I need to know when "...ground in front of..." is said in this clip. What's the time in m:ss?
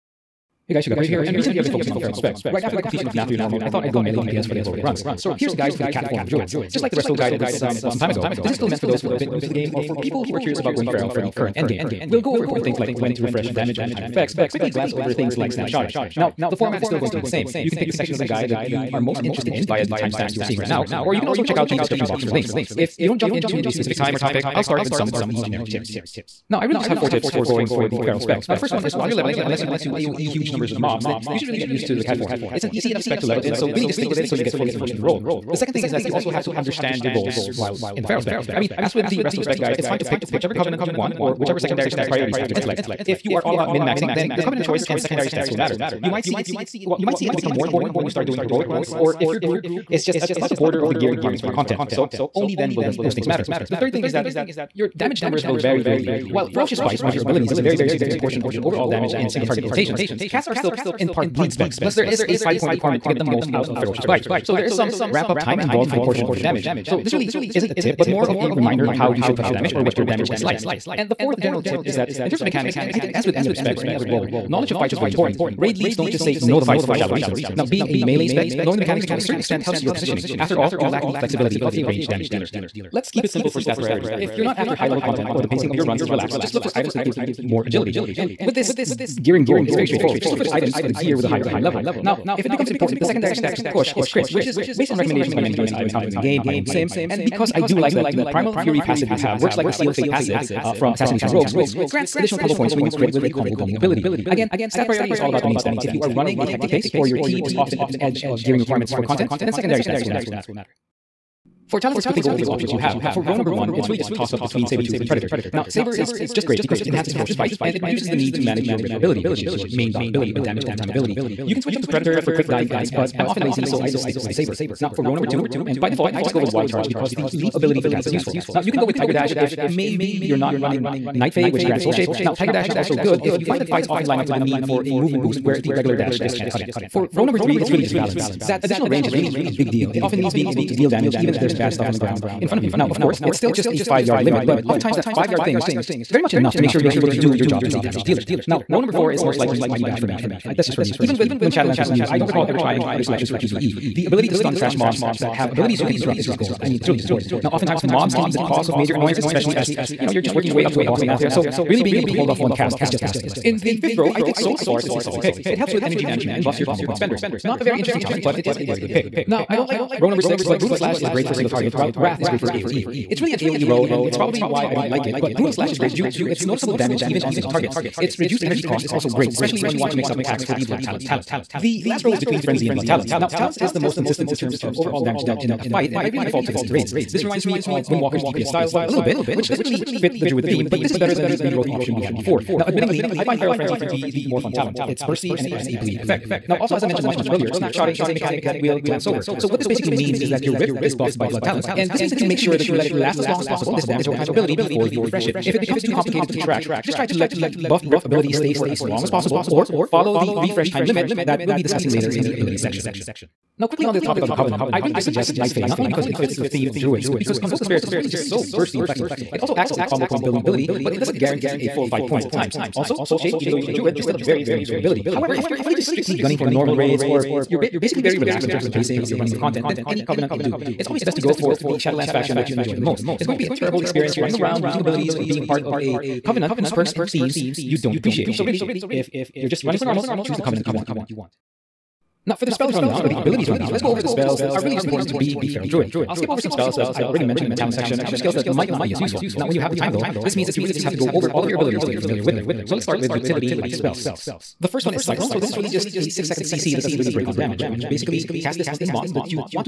2:21.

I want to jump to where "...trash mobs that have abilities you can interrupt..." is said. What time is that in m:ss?
2:34.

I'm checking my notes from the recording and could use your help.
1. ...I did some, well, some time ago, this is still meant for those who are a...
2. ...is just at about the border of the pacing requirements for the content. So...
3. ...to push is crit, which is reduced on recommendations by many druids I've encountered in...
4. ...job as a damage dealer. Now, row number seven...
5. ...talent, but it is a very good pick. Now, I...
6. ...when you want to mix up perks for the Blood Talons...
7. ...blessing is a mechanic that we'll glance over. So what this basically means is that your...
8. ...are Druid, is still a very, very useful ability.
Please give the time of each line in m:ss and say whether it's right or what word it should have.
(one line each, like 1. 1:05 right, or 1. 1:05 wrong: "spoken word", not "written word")
1. 0:07 right
2. 0:49 wrong: "gearing", not "pacing"
3. 1:33 wrong: "based", not "reduced"
4. 2:27 wrong: "four", not "seven"
5. 2:48 right
6. 2:59 wrong: "attacks", not "perks"
7. 3:17 wrong: "snapshotting", not "blessing"
8. 3:43 right.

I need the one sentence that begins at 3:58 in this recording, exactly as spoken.
So, really, if you're just running for normals, choose the Covenant you want.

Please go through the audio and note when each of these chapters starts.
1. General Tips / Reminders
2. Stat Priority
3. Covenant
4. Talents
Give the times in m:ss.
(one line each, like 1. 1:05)
1. 0:25
2. 1:22
3. 3:32
4. 1:49.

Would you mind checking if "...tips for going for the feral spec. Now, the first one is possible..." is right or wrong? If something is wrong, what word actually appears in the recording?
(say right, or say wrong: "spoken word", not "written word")
wrong: "while", not "possible".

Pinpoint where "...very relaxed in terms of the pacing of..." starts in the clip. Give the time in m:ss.
3:48.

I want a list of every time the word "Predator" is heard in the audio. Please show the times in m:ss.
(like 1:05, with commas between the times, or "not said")
1:55, 2:01.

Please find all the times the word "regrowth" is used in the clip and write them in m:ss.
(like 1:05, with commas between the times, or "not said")
3:11.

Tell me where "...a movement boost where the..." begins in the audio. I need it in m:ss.
2:14.